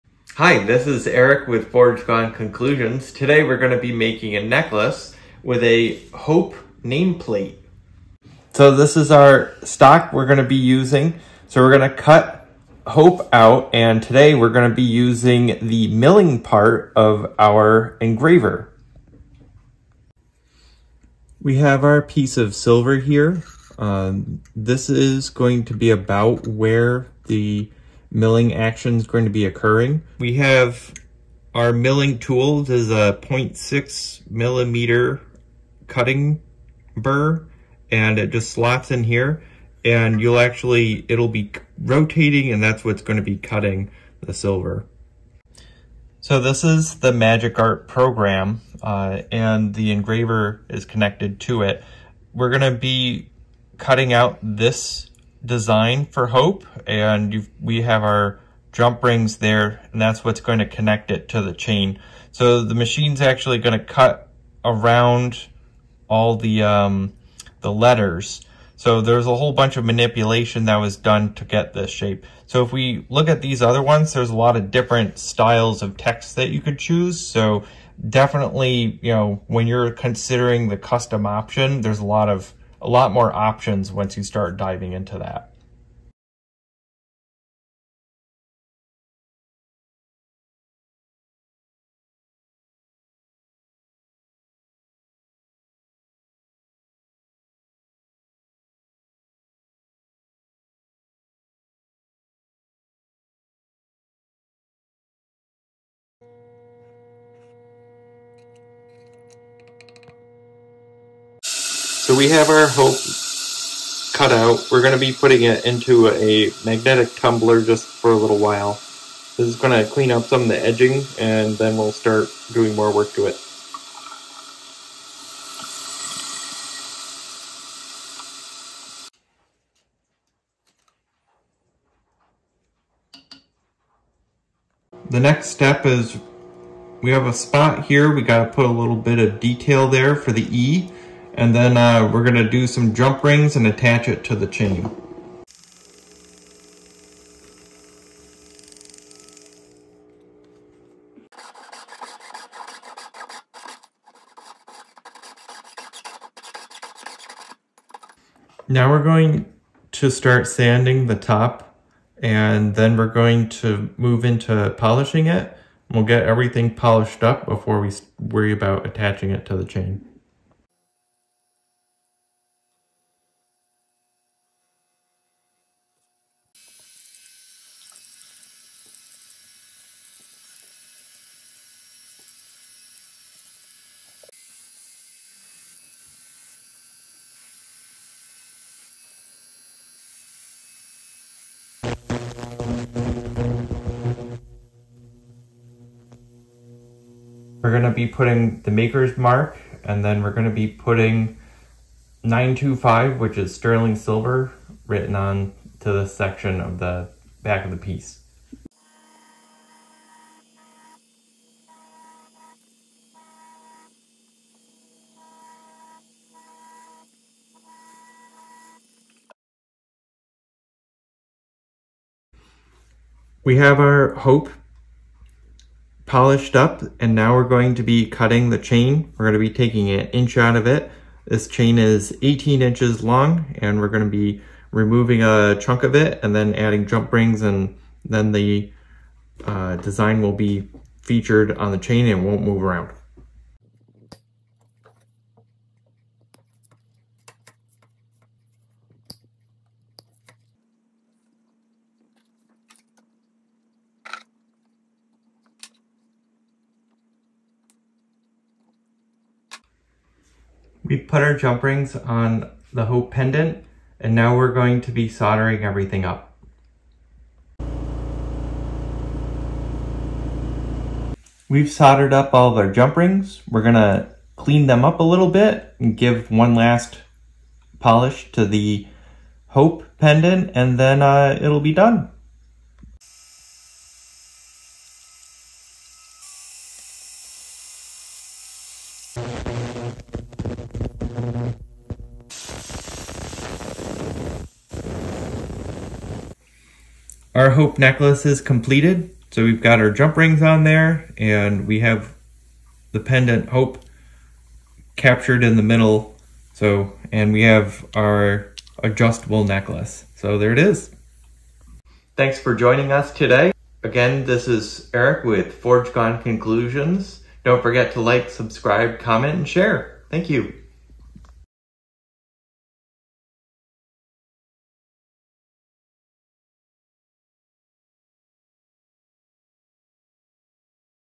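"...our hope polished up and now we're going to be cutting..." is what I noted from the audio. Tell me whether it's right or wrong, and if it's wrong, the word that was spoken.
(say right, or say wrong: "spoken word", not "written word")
right.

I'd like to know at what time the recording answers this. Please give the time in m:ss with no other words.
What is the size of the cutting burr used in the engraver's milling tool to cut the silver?
0:33.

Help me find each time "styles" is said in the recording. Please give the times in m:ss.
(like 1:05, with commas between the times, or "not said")
1:15.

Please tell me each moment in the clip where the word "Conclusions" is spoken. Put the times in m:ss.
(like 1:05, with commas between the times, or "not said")
0:02, 5:16.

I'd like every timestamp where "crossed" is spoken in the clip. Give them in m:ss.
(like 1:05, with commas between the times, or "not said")
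not said.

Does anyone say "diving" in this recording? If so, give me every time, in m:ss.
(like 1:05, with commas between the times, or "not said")
1:24.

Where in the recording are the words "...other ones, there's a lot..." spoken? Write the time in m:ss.
1:13.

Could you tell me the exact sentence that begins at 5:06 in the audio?
So, and we have our adjustable necklace.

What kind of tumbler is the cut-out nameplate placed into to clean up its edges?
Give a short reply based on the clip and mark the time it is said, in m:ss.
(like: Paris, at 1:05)
Magnetic tumbler, at 1:56.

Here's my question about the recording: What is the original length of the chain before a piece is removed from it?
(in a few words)
18 inches.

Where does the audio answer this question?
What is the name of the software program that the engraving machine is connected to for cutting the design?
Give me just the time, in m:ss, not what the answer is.
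0:47.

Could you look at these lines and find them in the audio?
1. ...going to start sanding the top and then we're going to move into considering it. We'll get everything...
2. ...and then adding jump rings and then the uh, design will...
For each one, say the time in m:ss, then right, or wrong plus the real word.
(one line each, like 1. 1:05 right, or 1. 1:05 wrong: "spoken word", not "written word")
1. 2:39 wrong: "polishing", not "considering"
2. 3:56 right.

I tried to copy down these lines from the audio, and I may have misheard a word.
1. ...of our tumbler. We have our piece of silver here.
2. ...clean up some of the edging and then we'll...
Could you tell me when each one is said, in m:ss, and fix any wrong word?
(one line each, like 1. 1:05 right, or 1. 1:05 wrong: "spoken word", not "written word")
1. 0:16 wrong: "engraver", not "tumbler"
2. 1:59 right.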